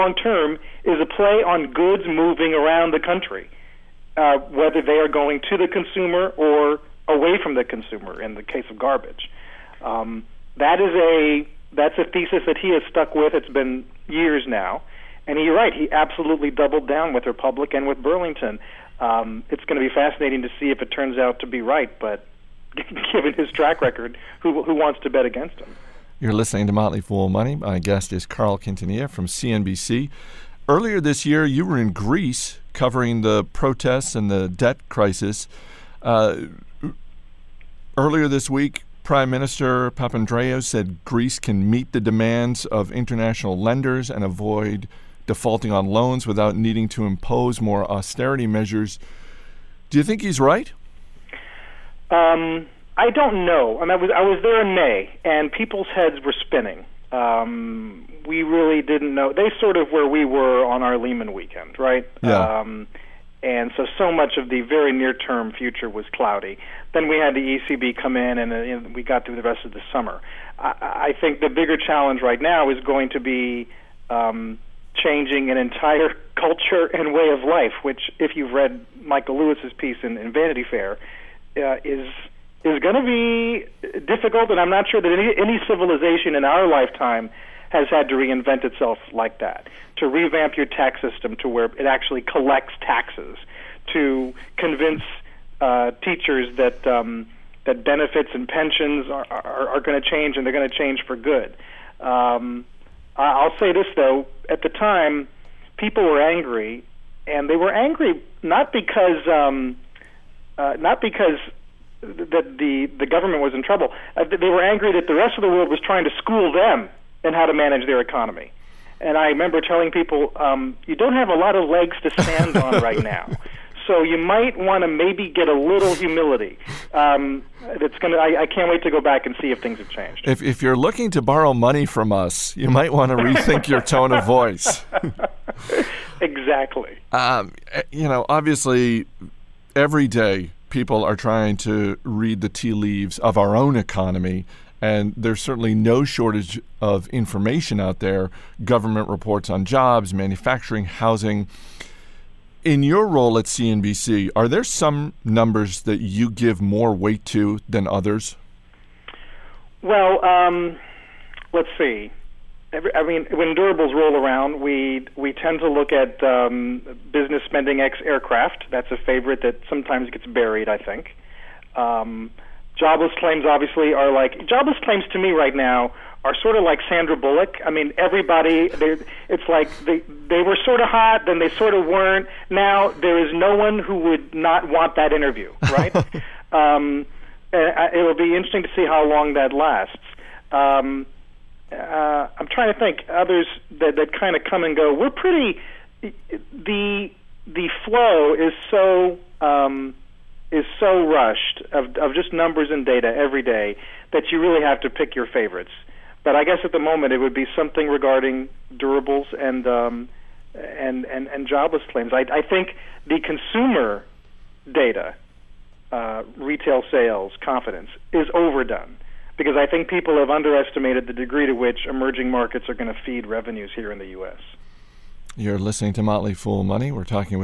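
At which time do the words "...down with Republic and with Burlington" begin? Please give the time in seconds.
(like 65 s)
16 s.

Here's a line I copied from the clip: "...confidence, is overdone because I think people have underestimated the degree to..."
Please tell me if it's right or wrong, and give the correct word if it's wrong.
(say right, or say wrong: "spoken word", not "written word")
right.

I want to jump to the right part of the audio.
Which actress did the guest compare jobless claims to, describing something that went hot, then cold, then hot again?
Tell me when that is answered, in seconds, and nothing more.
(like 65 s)
176 s.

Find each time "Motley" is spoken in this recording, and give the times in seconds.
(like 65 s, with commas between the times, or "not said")
26 s, 226 s.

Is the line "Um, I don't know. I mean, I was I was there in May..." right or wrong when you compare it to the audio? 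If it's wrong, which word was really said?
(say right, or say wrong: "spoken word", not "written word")
right.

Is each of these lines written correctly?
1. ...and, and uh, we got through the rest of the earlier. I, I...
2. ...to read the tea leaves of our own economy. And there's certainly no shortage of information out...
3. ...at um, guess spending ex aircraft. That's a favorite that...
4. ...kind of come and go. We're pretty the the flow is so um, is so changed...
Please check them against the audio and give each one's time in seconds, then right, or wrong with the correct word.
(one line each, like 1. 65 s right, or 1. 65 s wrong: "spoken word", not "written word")
1. 68 s wrong: "summer", not "earlier"
2. 141 s right
3. 165 s wrong: "business", not "guess"
4. 194 s wrong: "rushed", not "changed".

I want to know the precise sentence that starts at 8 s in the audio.
In the case of garbage, um, that is a that's a thesis that he has stuck with.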